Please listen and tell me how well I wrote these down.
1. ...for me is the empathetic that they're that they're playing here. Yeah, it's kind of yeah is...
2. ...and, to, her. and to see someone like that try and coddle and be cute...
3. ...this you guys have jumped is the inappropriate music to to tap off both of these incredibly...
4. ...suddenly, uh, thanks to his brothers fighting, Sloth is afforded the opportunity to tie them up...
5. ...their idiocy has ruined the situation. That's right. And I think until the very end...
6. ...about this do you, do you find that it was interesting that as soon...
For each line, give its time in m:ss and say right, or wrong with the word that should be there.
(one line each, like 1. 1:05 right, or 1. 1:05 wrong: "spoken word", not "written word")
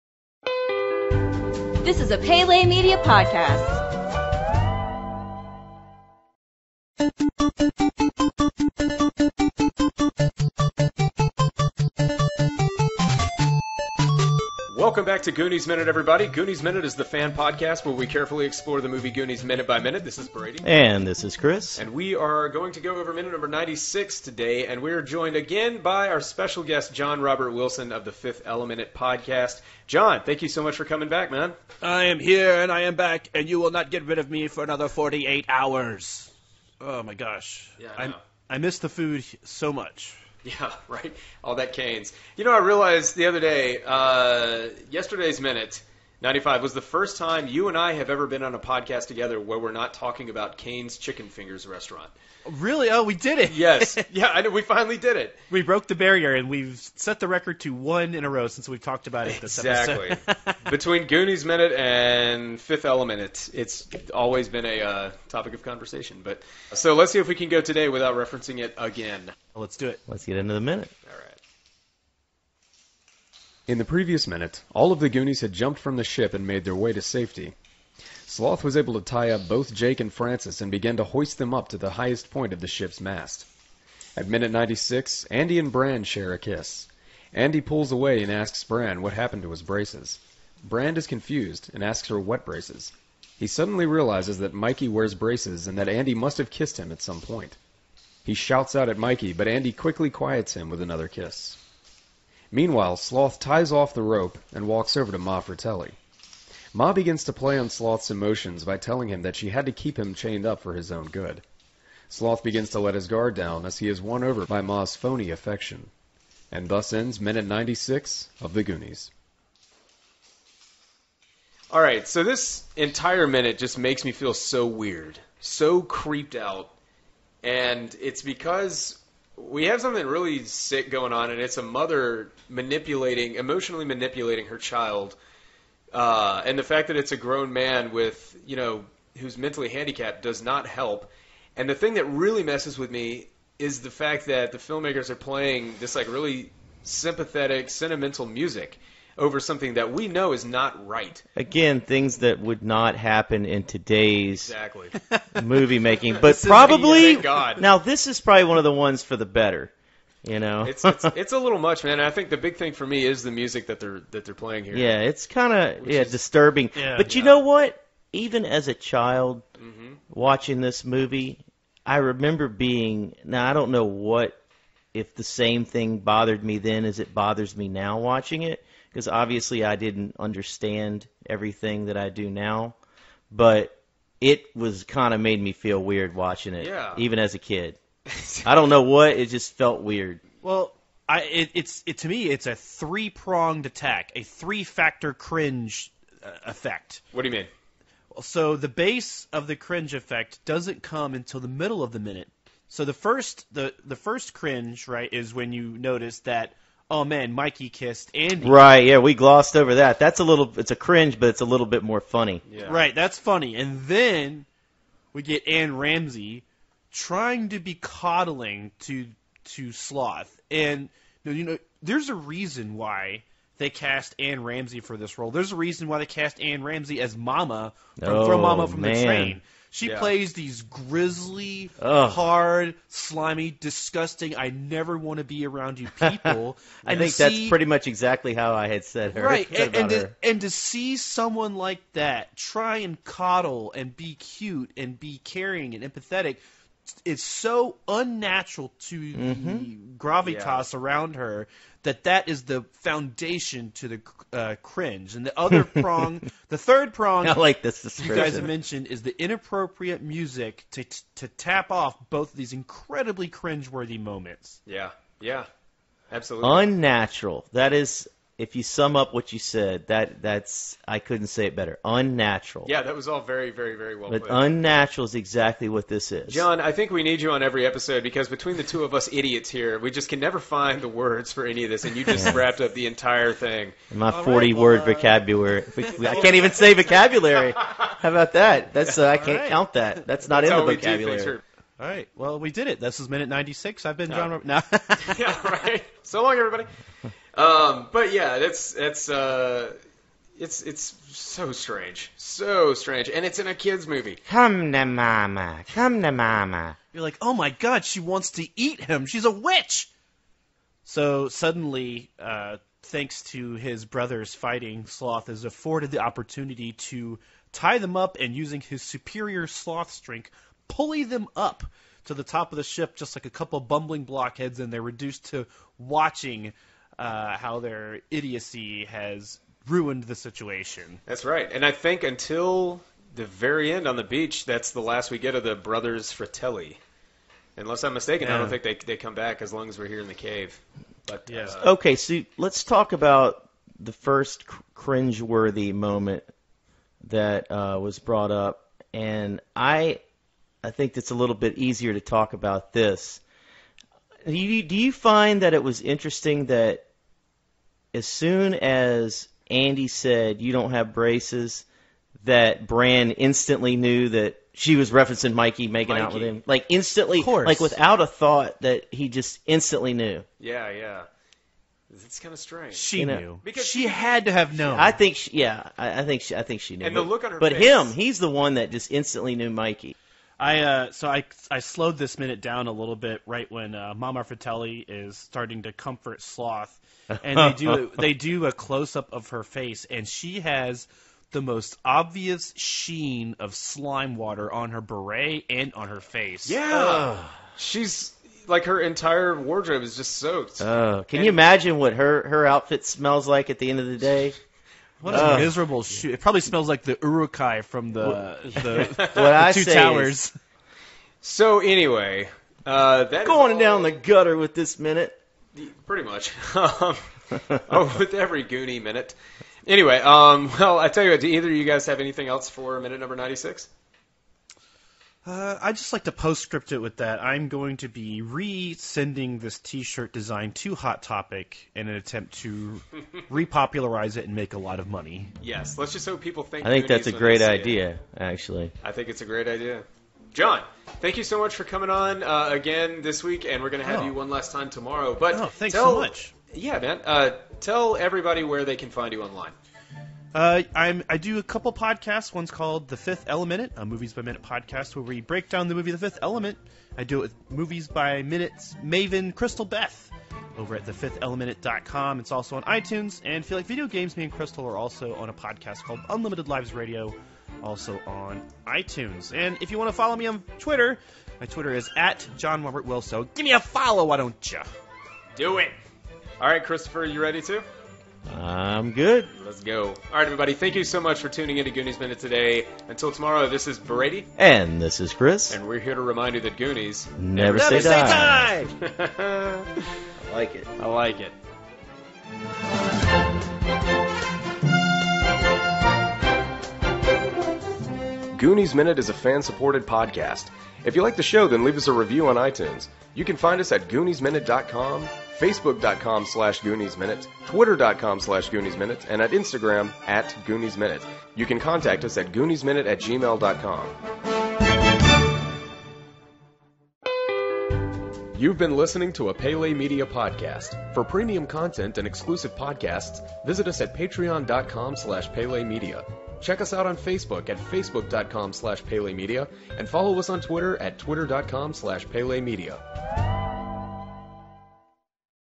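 1. 2:42 wrong: "music", not "empathetic"
2. 3:59 right
3. 4:17 wrong: "mentioned", not "jumped"
4. 5:11 right
5. 5:27 right
6. 5:52 right.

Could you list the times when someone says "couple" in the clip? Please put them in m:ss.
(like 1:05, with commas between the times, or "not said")
5:23, 7:31.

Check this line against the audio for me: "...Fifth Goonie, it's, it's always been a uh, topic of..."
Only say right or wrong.
wrong.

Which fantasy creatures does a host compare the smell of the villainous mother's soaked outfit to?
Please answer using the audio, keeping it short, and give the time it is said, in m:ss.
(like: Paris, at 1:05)
Uruk-hai, at 6:47.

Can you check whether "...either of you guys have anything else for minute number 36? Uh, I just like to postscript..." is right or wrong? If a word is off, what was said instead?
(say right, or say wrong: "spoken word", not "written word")
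wrong: "96", not "36".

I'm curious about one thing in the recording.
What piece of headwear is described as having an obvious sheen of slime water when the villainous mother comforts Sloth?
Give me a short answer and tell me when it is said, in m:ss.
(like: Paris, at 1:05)
beret, at 6:34.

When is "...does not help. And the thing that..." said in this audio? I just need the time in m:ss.
2:20.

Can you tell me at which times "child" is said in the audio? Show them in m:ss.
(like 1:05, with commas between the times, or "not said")
2:14, 2:48.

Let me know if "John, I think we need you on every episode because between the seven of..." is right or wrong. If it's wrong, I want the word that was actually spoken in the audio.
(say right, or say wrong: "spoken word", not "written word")
wrong: "two", not "seven".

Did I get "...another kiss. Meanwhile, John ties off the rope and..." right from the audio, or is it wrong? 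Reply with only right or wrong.
wrong.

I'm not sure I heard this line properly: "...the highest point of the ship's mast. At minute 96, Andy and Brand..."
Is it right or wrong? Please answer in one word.
right.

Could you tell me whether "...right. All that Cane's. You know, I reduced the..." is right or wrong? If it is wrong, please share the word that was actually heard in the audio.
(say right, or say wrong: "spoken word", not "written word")
wrong: "realized", not "reduced".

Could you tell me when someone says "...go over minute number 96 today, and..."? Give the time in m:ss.
0:22.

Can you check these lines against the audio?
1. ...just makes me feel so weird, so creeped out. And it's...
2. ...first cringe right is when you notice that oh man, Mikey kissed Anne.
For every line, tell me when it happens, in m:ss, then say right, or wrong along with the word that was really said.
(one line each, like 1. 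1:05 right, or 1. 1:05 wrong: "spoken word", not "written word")
1. 2:03 right
2. 3:23 wrong: "Andy", not "Anne".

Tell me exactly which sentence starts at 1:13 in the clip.
In the previous minute, all of the Goonies had jumped from the ship and made their way to safety.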